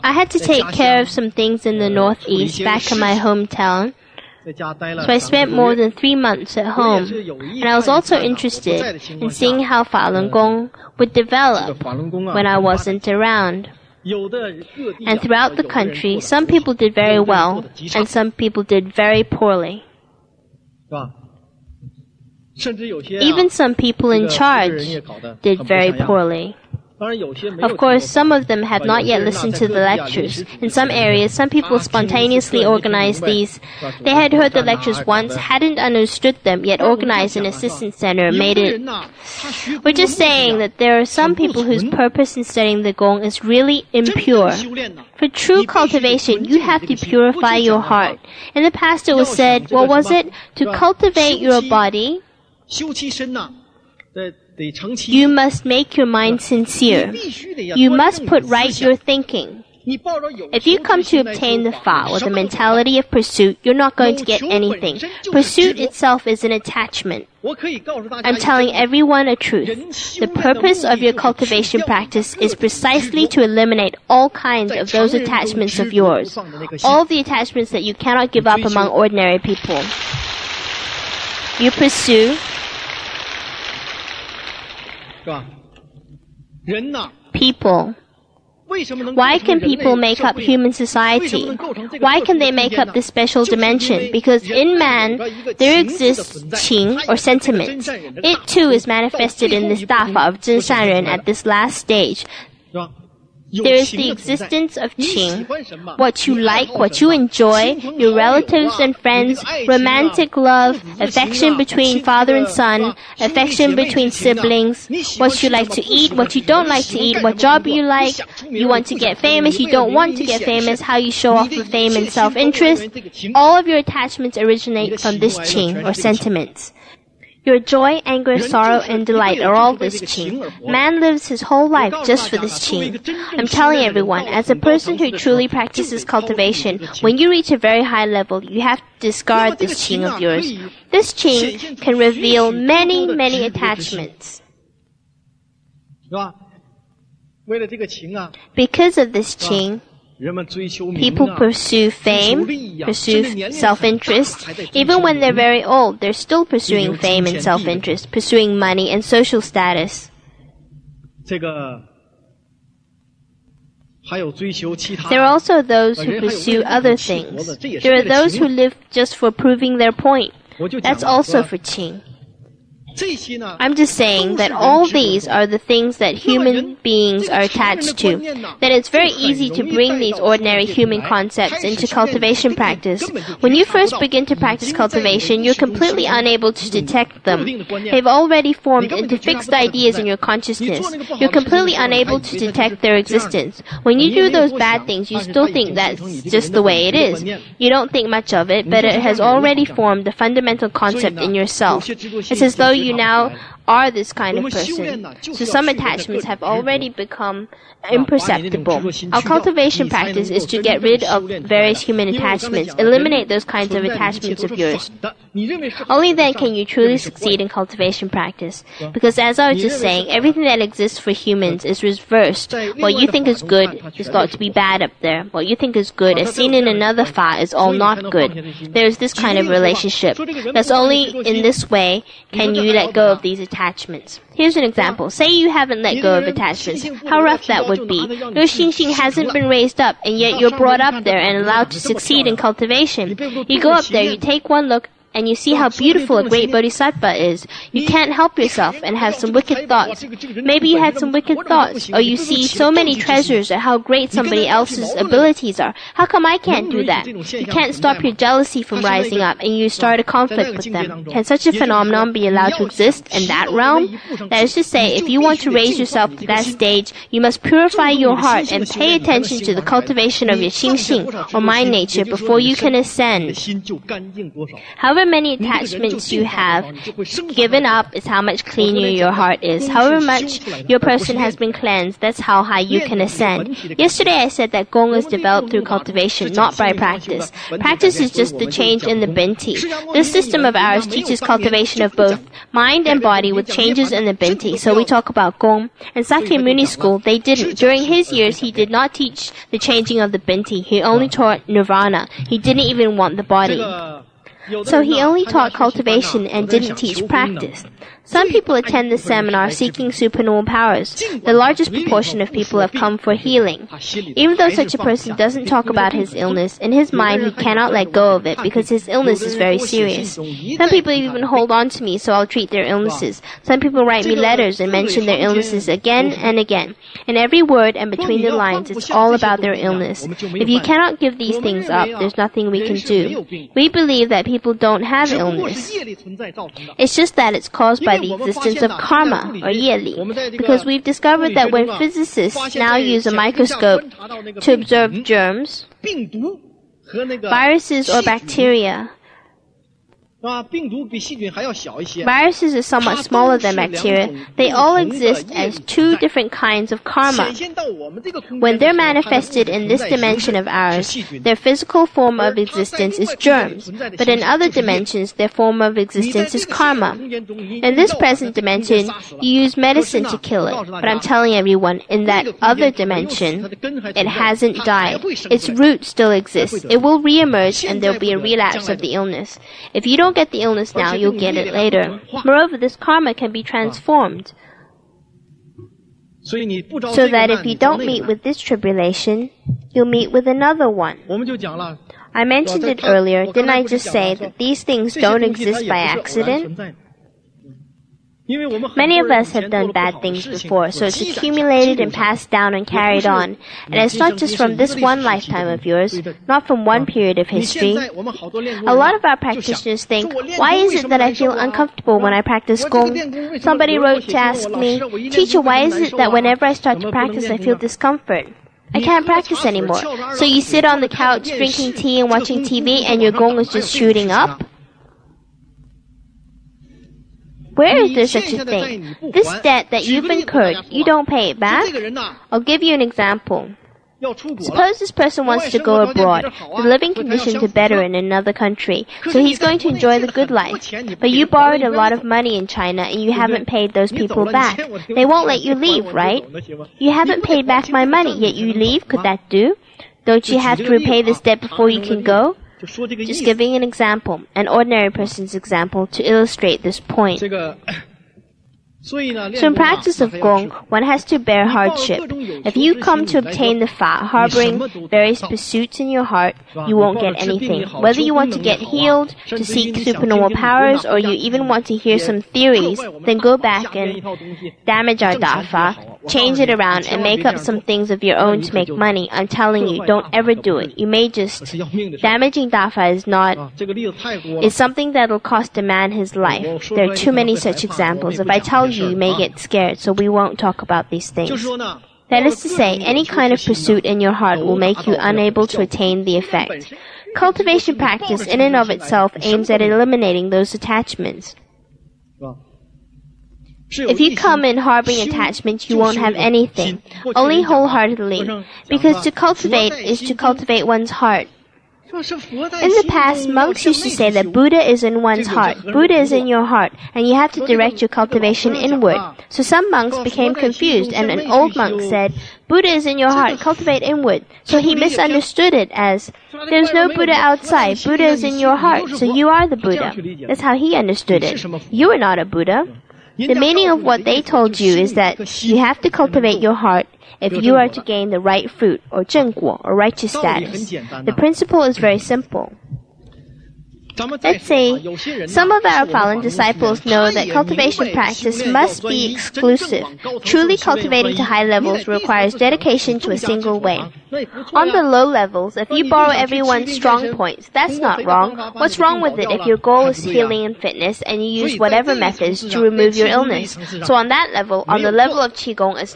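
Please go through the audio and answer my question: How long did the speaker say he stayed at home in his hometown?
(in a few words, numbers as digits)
more than three months.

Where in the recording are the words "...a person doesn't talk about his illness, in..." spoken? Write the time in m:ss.
5:14.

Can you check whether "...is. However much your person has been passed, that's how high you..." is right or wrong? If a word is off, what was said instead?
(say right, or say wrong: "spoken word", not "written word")
wrong: "cleansed", not "passed".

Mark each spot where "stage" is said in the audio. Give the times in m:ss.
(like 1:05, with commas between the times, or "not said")
1:41, 4:26.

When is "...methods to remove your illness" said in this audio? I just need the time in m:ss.
9:21.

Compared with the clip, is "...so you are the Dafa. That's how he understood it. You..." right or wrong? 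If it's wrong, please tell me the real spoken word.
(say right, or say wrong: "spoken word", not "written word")
wrong: "Buddha", not "Dafa".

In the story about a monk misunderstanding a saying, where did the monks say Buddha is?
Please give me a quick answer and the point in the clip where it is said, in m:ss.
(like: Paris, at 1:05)
in one's heart, at 8:34.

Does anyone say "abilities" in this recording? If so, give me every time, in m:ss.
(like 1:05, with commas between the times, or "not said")
4:14.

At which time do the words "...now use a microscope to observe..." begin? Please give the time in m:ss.
5:42.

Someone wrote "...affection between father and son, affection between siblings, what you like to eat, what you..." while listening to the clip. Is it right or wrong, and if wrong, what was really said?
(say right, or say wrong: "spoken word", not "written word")
right.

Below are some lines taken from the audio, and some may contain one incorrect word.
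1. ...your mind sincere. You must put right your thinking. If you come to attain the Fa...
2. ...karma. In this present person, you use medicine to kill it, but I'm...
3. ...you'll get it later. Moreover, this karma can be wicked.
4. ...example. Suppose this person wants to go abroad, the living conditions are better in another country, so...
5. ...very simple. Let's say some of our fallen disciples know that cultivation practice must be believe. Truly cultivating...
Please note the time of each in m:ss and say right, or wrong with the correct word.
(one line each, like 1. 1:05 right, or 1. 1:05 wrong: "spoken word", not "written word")
1. 0:55 wrong: "obtain", not "attain"
2. 6:06 wrong: "dimension", not "person"
3. 6:20 wrong: "transformed", not "wicked"
4. 7:12 right
5. 9:01 wrong: "exclusive", not "believe".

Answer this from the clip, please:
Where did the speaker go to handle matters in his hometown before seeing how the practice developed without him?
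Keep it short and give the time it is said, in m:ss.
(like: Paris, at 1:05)
the Northeast, at 0:01.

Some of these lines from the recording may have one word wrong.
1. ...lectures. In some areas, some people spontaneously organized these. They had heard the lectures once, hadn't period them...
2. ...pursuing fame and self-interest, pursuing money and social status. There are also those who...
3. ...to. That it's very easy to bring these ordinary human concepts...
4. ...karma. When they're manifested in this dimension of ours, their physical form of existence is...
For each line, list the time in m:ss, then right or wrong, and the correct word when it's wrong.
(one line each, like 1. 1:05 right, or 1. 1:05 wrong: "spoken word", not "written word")
1. 0:29 wrong: "understood", not "period"
2. 2:36 right
3. 2:57 right
4. 5:56 right.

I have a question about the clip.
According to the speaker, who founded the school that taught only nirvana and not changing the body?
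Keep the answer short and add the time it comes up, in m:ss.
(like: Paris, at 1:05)
Sakyamuni, at 4:56.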